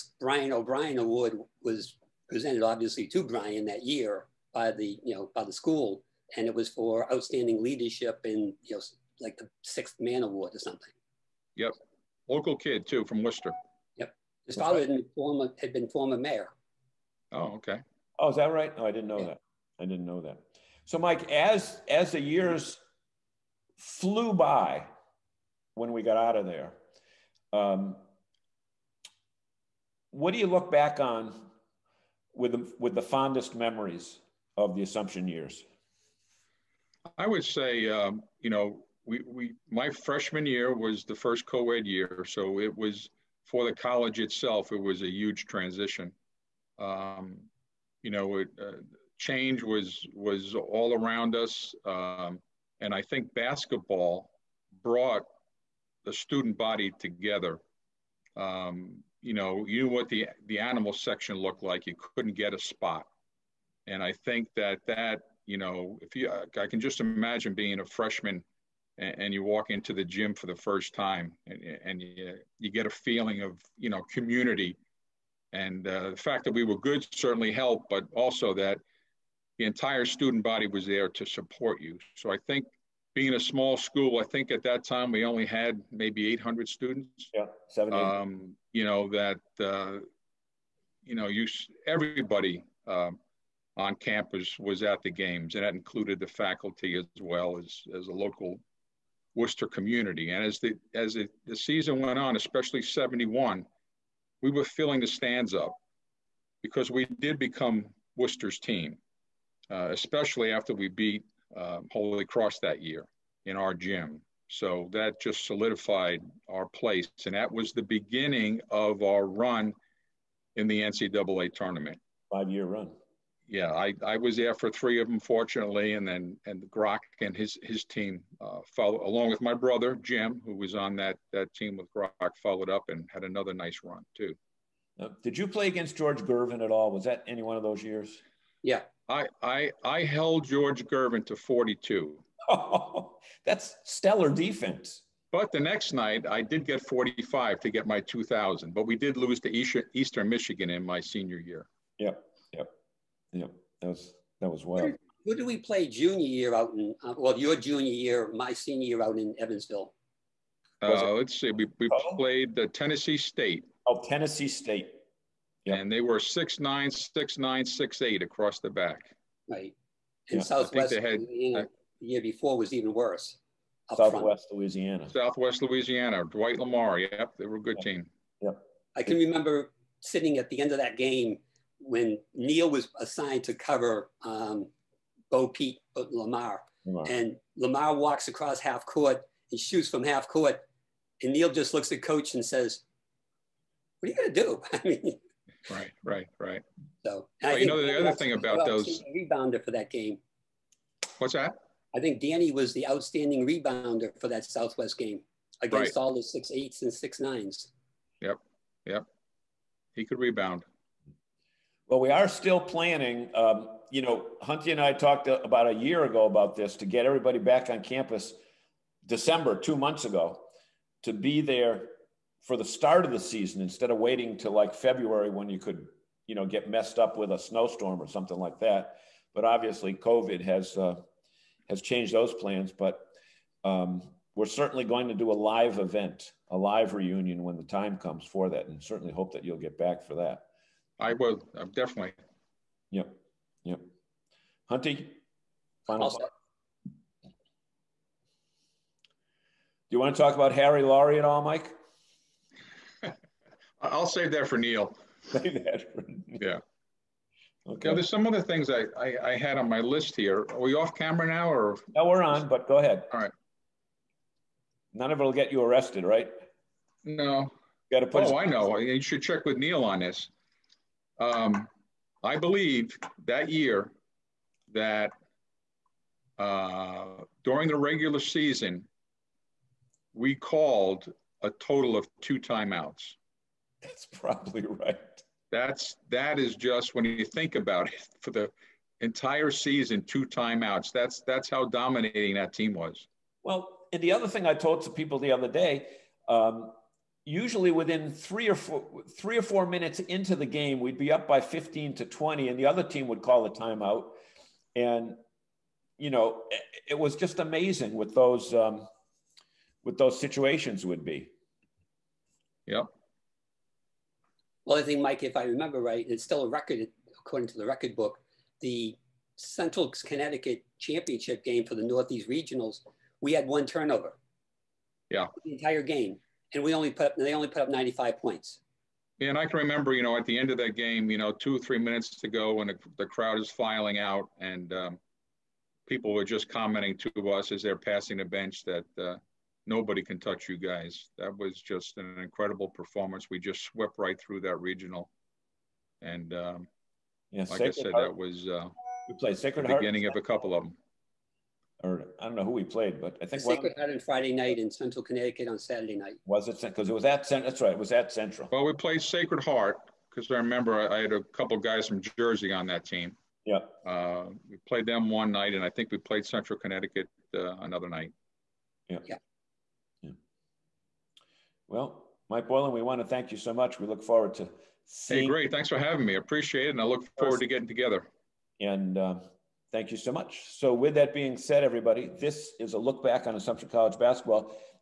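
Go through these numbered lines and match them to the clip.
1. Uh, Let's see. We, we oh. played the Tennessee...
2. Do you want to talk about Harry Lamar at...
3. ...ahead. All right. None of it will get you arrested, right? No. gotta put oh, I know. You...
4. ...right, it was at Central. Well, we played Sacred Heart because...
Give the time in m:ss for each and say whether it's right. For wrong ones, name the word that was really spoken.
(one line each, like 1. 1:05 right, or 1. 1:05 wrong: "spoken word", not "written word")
1. 2:40 right
2. 4:07 wrong: "Laurie", not "Lamar"
3. 4:22 right
4. 5:57 right.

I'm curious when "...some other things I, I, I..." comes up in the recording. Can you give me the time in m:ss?
4:18.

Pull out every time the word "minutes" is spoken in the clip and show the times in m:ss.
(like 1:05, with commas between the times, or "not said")
4:59, 5:31.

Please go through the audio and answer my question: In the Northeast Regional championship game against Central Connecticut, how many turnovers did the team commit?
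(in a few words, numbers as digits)
1.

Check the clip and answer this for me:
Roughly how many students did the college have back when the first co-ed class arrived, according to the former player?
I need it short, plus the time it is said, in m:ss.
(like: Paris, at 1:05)
800, at 1:26.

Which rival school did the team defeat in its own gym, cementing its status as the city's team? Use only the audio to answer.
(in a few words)
Holy Cross.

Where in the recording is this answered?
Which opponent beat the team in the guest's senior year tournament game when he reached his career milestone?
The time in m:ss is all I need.
2:29.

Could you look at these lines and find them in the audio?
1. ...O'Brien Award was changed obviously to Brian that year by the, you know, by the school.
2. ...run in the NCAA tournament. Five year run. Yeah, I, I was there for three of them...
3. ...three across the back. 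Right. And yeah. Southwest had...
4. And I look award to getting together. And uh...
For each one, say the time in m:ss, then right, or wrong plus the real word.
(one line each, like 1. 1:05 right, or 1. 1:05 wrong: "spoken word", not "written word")
1. 0:00 wrong: "presented", not "changed"
2. 1:59 right
3. 2:48 wrong: "eight", not "three"
4. 6:16 wrong: "forward", not "award".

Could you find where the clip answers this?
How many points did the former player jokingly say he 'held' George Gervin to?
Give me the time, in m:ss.
2:21.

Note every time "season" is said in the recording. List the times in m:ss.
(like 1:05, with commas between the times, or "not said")
1:41, 3:43, 4:38, 4:49.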